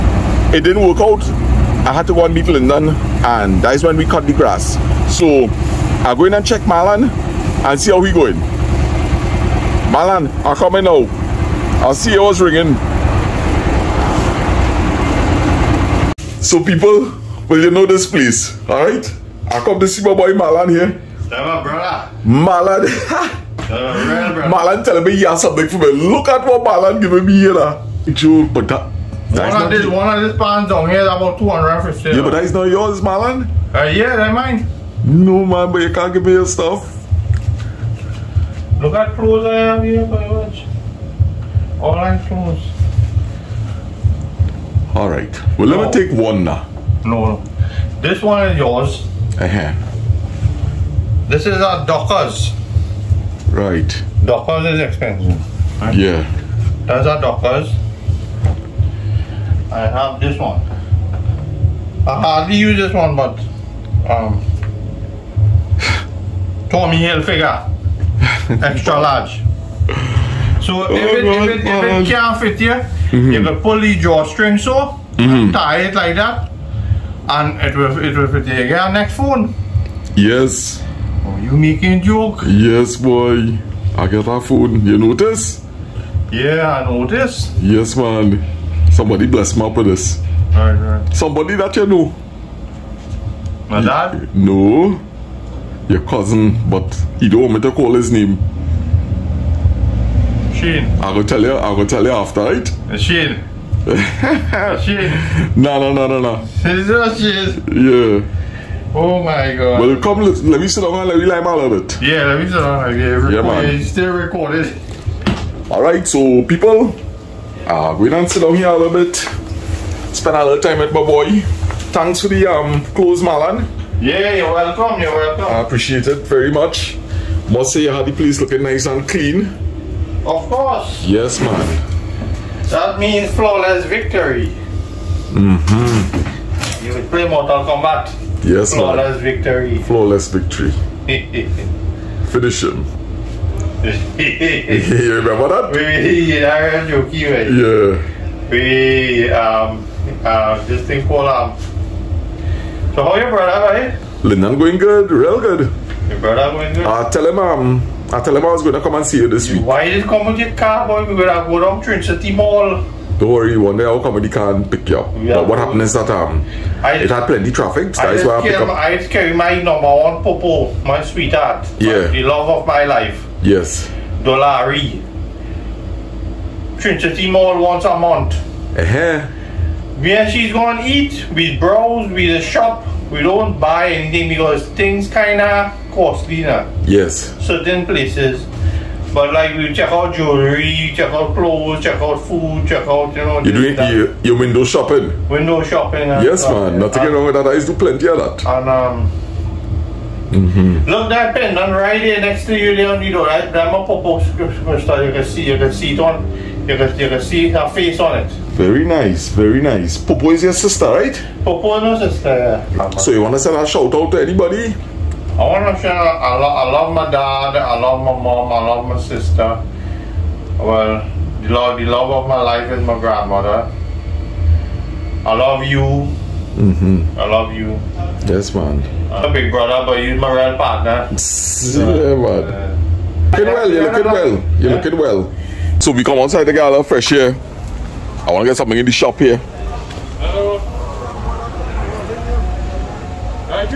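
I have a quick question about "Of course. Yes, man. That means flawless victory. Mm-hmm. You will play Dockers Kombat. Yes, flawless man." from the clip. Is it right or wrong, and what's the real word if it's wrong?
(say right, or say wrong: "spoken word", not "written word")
wrong: "Mortal", not "Dockers".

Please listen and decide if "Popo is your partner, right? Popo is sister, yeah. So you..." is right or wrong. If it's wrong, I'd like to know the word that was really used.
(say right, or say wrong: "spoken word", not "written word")
wrong: "sister", not "partner".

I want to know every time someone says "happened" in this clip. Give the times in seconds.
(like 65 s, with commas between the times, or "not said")
165 s.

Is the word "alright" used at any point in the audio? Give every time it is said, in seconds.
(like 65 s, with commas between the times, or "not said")
18 s, 115 s.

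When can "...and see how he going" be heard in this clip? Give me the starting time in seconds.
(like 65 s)
7 s.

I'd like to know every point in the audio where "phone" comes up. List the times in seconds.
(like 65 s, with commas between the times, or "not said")
79 s, 84 s.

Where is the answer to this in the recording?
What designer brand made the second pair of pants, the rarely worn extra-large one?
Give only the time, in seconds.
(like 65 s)
66 s.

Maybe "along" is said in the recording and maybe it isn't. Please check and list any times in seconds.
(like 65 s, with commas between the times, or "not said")
not said.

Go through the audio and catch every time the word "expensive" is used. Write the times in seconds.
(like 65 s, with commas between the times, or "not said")
54 s.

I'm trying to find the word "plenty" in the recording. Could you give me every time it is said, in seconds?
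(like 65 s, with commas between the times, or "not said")
167 s, 197 s.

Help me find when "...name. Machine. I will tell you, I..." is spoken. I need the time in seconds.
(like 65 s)
98 s.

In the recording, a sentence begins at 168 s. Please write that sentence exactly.
I carry my number one popo, my sweetheart.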